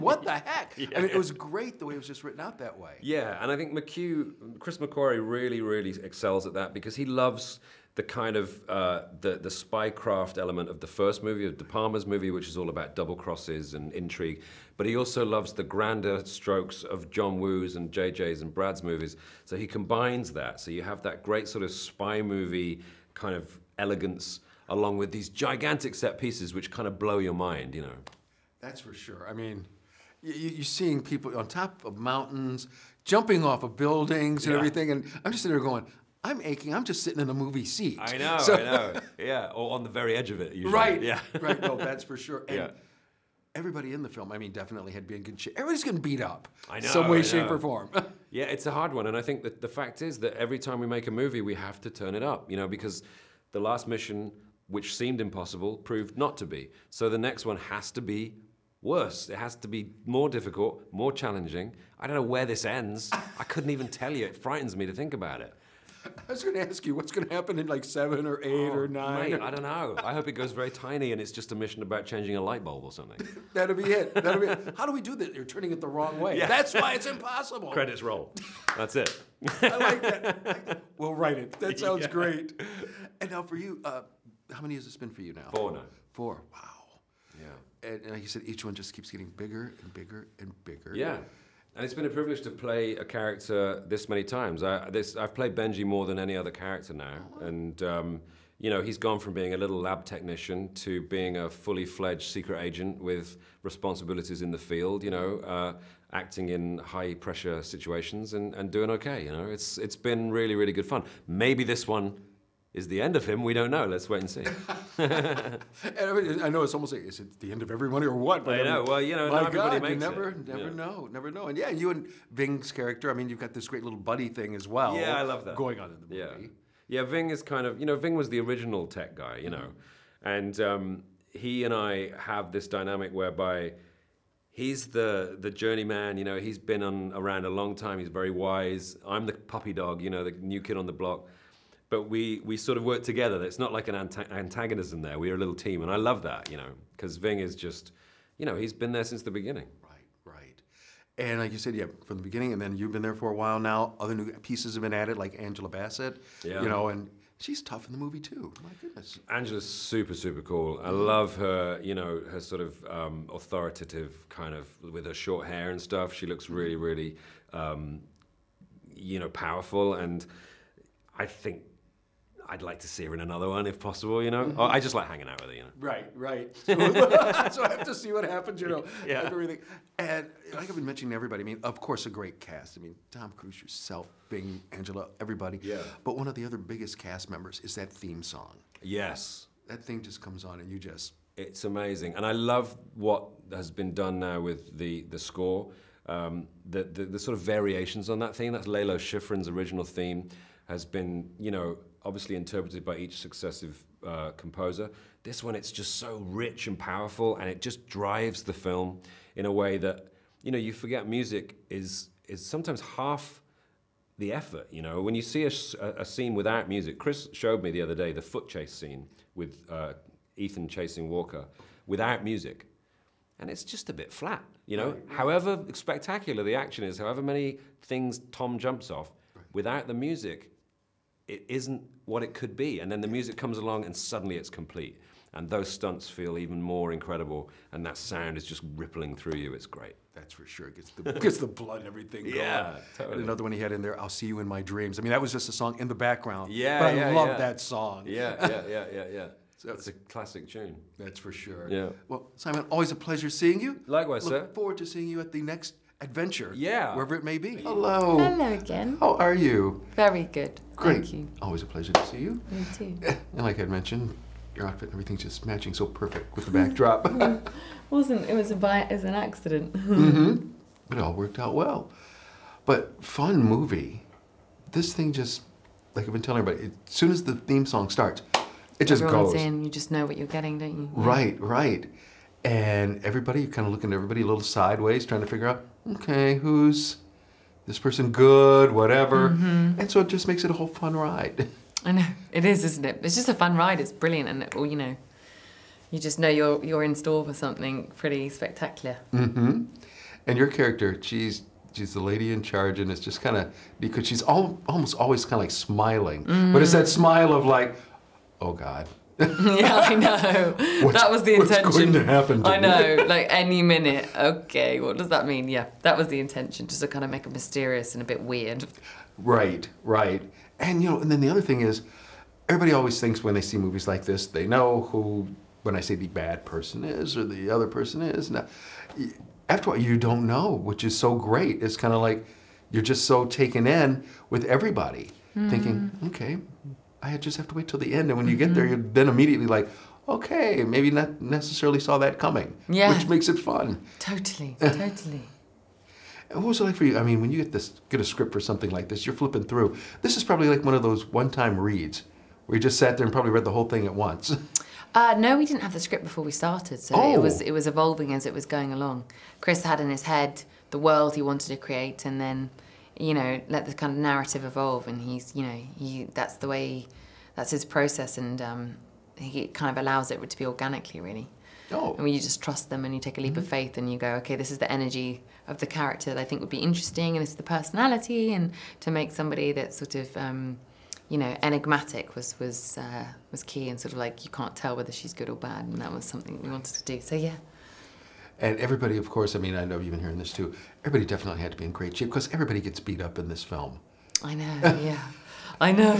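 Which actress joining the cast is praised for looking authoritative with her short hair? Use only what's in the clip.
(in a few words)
Angela Bassett.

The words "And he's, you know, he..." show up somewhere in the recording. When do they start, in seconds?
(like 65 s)
364 s.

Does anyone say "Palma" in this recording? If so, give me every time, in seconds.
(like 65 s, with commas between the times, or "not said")
11 s.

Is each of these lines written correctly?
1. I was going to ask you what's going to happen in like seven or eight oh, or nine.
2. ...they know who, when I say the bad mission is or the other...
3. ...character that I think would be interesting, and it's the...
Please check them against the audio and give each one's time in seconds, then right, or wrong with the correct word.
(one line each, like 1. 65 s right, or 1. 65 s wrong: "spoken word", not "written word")
1. 66 s right
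2. 324 s wrong: "person", not "mission"
3. 375 s right.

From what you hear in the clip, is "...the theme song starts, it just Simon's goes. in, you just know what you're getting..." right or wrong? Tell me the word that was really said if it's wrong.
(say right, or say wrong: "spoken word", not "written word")
wrong: "Everyone", not "Simon".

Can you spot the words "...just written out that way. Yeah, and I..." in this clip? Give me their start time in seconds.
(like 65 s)
2 s.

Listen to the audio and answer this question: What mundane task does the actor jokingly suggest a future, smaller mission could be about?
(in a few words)
changing a light bulb.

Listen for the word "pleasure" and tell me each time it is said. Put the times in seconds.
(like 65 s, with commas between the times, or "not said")
252 s, 261 s.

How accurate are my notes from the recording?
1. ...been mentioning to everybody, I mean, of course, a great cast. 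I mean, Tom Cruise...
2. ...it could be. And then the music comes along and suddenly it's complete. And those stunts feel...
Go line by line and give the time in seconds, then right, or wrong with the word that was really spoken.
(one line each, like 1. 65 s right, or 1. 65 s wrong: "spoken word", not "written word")
1. 180 s right
2. 232 s right.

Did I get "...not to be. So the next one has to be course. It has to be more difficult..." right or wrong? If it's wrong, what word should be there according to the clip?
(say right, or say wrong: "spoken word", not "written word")
wrong: "worse", not "course".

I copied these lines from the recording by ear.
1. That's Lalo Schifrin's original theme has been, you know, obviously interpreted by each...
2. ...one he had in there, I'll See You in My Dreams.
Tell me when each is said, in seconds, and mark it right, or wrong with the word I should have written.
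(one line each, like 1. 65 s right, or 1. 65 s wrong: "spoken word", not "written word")
1. 198 s right
2. 243 s right.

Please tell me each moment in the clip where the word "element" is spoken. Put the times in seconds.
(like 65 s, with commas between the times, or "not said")
10 s.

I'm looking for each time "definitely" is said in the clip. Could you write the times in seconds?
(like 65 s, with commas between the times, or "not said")
44 s, 391 s.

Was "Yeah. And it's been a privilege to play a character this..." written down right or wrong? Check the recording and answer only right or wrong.
right.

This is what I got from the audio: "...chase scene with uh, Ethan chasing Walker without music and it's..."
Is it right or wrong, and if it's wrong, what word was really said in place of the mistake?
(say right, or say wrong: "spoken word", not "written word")
right.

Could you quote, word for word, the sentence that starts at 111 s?
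Maybe this one is the end of him, we don't know.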